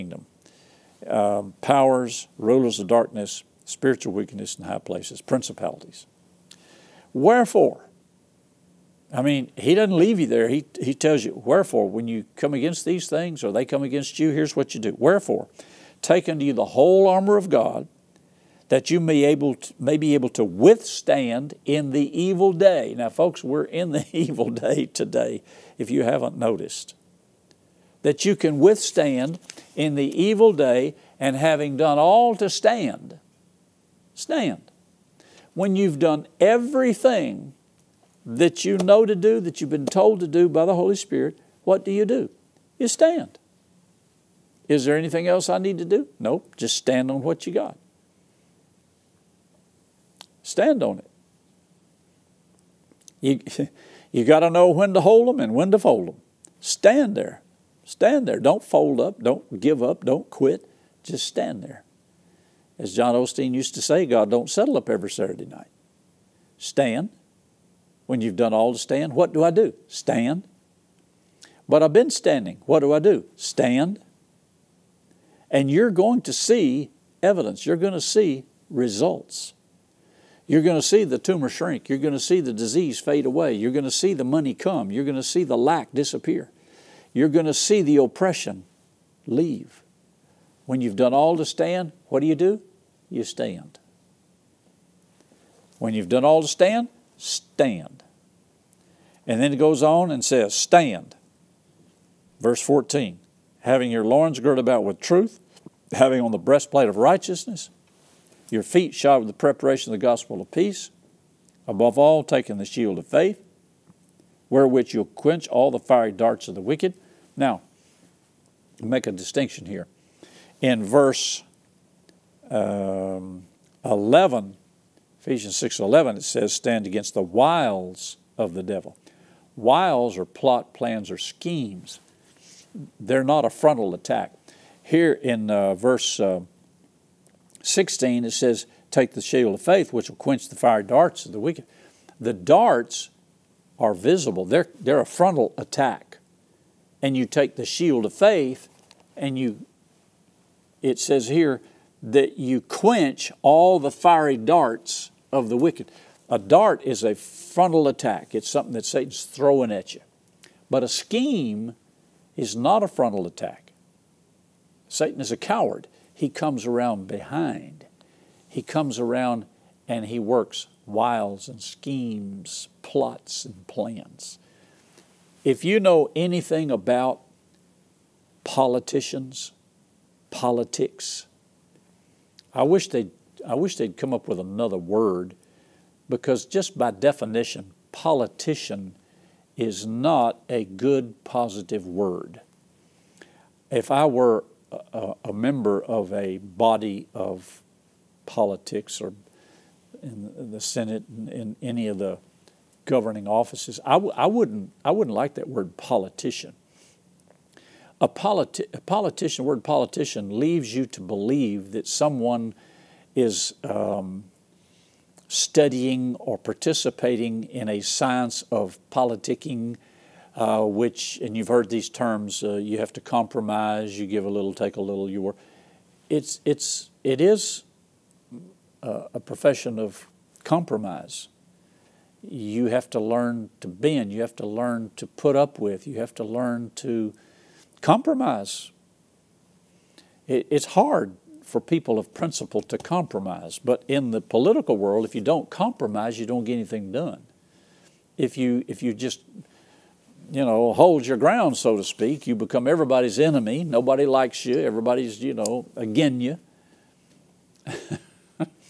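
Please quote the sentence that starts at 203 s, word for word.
I w- I wouldn't I wouldn't like that word politician.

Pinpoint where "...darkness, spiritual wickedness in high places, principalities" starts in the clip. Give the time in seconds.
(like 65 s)
2 s.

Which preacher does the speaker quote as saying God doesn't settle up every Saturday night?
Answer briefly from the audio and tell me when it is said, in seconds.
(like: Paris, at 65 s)
John Osteen, at 62 s.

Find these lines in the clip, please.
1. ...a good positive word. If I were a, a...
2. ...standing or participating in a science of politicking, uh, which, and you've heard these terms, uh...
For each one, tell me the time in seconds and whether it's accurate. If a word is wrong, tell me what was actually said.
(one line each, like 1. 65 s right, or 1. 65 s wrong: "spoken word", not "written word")
1. 190 s right
2. 215 s wrong: "studying", not "standing".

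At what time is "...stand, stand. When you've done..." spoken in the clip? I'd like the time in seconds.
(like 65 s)
32 s.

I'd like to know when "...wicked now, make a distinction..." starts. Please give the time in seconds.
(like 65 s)
116 s.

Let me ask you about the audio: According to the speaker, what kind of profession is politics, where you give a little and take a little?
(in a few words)
a profession of compromise.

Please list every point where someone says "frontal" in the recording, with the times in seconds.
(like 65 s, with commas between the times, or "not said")
133 s, 145 s, 157 s, 162 s.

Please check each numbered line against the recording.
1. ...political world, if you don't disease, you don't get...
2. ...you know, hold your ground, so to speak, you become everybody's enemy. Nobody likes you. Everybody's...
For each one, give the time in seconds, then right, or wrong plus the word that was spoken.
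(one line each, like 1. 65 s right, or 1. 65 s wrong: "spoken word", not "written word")
1. 244 s wrong: "compromise", not "disease"
2. 250 s right.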